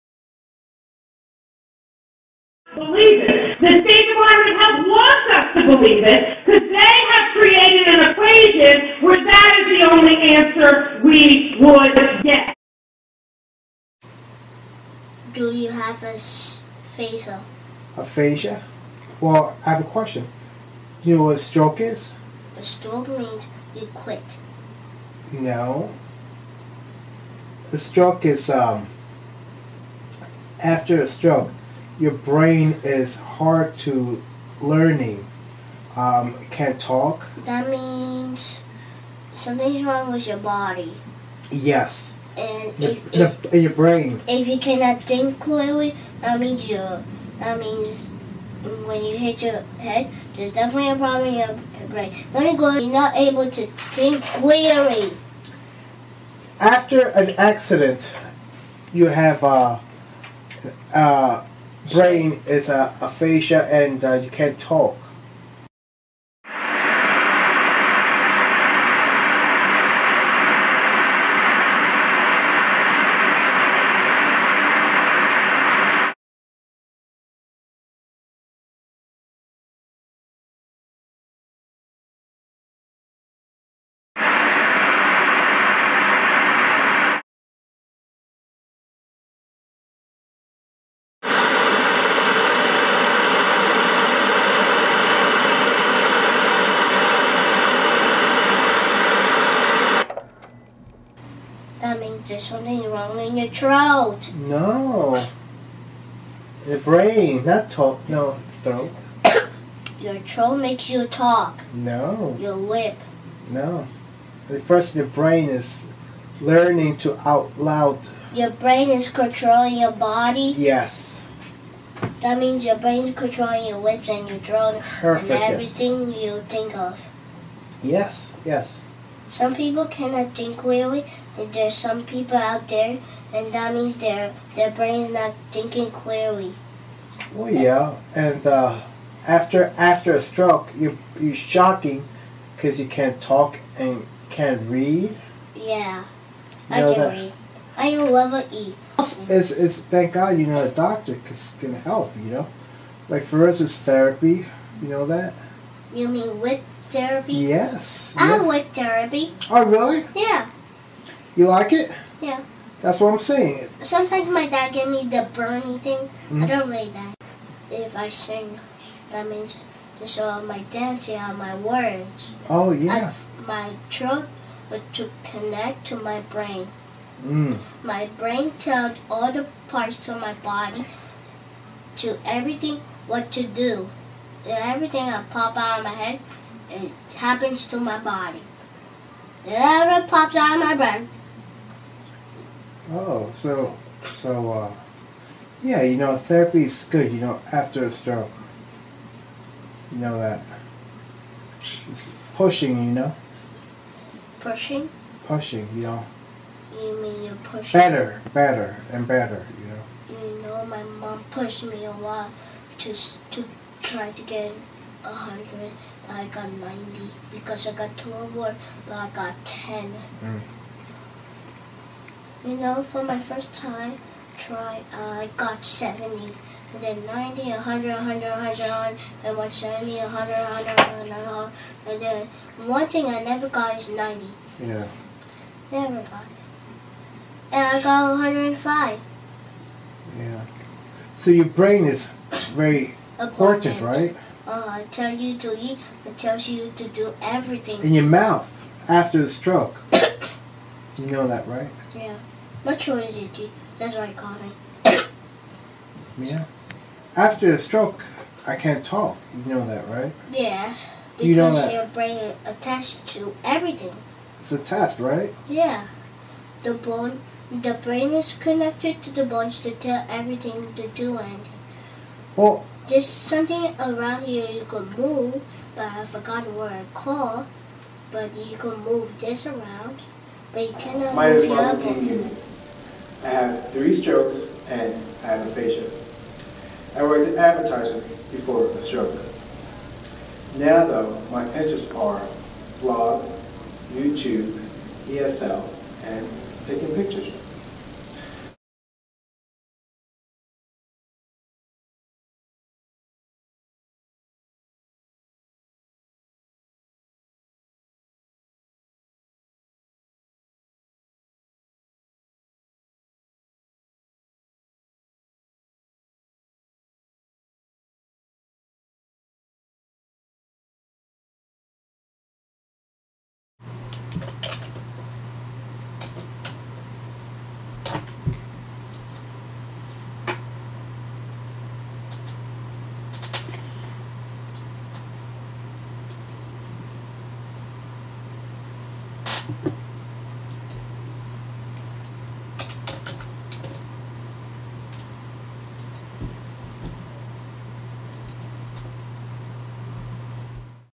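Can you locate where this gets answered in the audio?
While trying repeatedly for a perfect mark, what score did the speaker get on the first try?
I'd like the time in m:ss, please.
3:45.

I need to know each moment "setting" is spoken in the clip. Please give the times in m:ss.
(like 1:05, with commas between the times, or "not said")
not said.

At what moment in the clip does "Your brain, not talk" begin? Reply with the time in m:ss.
1:46.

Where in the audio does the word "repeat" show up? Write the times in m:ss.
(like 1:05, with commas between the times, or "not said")
not said.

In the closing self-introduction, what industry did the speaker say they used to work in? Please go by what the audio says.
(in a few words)
Advertising.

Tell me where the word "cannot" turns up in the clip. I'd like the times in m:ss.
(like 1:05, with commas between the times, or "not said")
0:44, 2:09, 4:40.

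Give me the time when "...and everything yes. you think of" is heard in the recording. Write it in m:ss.
2:05.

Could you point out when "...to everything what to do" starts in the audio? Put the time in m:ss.
3:02.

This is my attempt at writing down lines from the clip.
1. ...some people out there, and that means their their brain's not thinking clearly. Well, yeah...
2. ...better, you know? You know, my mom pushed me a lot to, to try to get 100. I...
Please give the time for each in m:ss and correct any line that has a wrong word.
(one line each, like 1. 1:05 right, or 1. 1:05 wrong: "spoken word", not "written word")
1. 2:11 right
2. 3:29 right.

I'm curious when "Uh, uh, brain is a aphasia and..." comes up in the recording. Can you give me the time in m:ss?
0:59.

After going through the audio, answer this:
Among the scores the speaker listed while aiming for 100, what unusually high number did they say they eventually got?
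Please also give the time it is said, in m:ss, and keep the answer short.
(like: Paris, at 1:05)
105, at 3:58.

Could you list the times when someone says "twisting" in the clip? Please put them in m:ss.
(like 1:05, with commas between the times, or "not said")
not said.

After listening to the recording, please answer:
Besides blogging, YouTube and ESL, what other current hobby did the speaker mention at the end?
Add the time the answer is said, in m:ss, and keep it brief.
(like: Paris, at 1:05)
Taking pictures, at 4:56.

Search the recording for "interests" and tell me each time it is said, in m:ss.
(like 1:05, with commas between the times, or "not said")
4:51.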